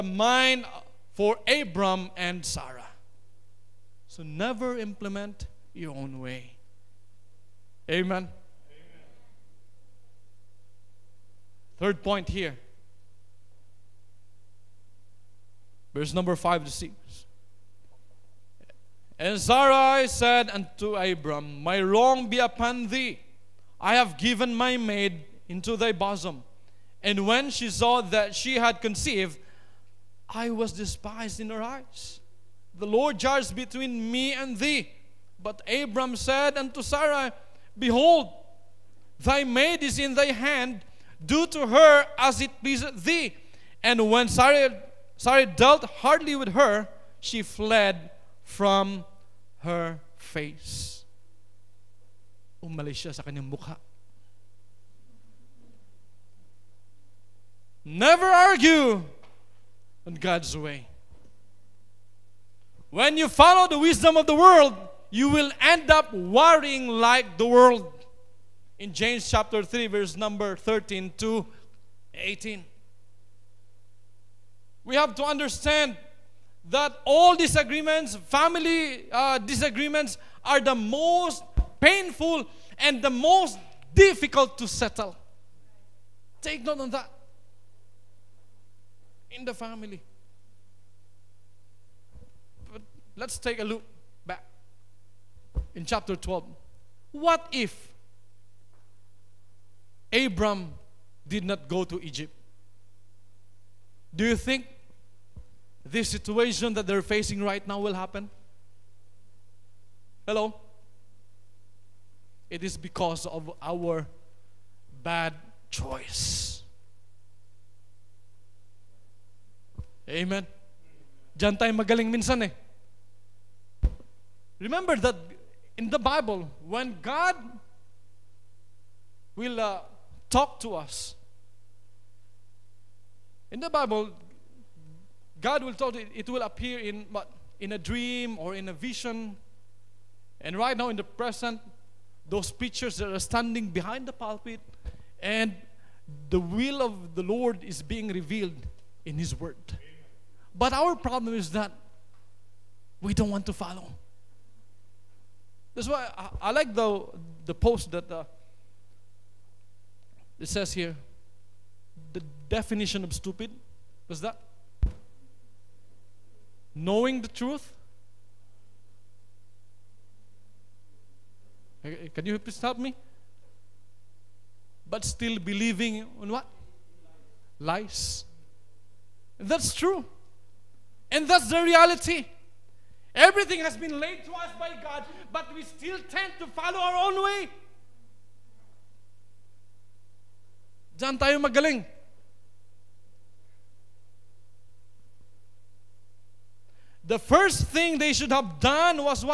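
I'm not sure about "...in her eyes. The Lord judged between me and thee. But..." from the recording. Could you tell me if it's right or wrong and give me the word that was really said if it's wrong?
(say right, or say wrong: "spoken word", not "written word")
right.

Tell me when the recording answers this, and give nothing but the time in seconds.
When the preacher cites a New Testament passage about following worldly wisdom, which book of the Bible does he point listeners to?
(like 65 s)
68 s.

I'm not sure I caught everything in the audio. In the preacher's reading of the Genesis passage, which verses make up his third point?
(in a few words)
5 to 6.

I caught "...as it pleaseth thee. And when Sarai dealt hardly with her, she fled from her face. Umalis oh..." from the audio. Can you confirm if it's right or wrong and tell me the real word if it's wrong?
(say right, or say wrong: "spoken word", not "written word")
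right.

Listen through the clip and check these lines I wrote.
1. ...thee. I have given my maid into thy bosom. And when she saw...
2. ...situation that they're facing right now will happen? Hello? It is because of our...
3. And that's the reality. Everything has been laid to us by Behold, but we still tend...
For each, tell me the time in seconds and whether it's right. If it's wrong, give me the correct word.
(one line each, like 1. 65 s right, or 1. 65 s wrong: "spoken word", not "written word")
1. 22 s right
2. 106 s right
3. 181 s wrong: "God", not "Behold".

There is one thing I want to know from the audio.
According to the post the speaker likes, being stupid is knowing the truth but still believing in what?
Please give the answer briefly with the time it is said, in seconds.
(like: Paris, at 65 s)
Lies, at 177 s.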